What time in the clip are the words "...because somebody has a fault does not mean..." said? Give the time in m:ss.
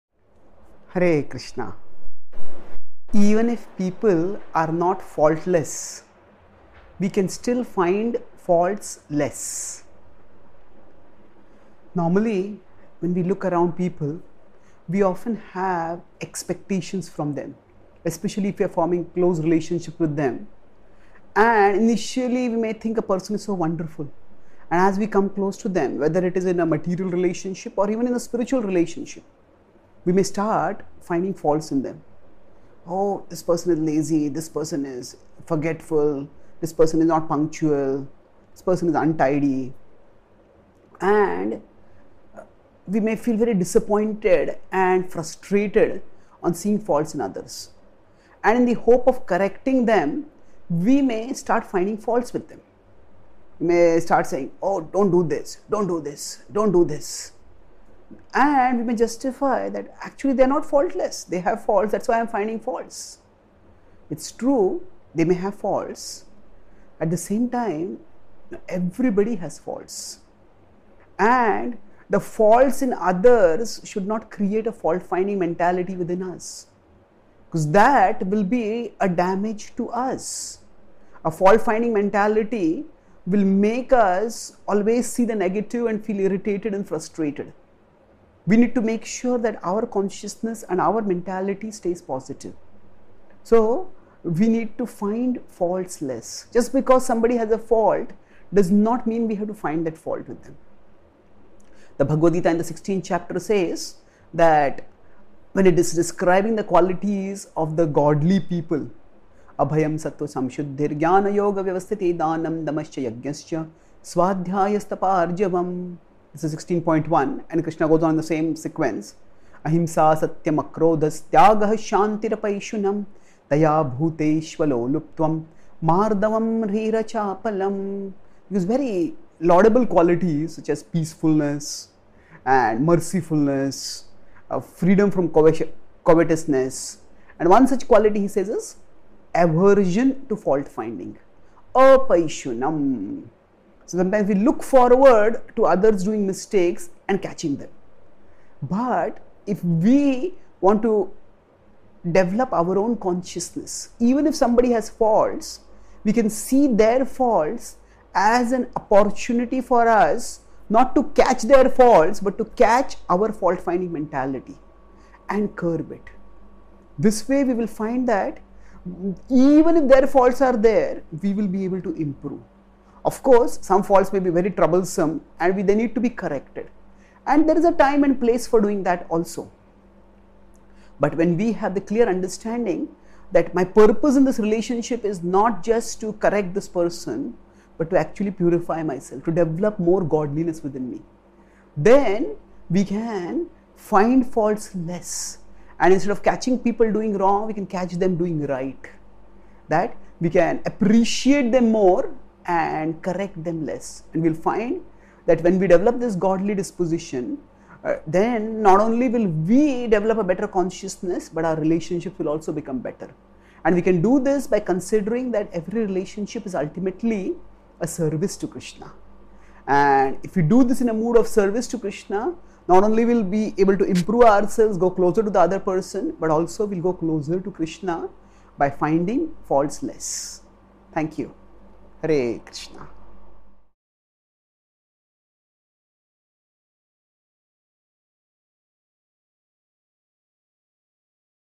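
1:36.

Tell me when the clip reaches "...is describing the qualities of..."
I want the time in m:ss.
1:45.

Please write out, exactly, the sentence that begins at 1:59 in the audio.
Ahimsa satyam akrodhas tyagah shantirapaishunam taya bhuteshvalo luptvam mardavam rirachapalam.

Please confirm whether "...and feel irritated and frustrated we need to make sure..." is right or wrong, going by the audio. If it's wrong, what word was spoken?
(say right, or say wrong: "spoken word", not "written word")
right.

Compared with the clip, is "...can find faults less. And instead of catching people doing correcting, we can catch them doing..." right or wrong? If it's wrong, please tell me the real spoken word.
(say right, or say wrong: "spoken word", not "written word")
wrong: "wrong", not "correcting".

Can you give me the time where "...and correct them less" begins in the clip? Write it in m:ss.
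3:22.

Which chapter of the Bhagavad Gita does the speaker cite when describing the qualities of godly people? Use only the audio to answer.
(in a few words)
16th chapter.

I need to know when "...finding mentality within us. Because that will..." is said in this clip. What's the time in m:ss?
1:15.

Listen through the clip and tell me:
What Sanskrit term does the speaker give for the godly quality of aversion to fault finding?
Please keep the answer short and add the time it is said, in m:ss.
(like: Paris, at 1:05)
Apaishunam, at 2:21.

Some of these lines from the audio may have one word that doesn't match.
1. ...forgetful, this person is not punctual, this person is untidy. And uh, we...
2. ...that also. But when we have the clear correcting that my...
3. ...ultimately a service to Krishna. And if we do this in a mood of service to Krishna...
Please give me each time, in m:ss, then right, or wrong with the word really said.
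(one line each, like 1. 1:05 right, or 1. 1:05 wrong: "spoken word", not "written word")
1. 0:35 right
2. 2:58 wrong: "understanding", not "correcting"
3. 3:36 right.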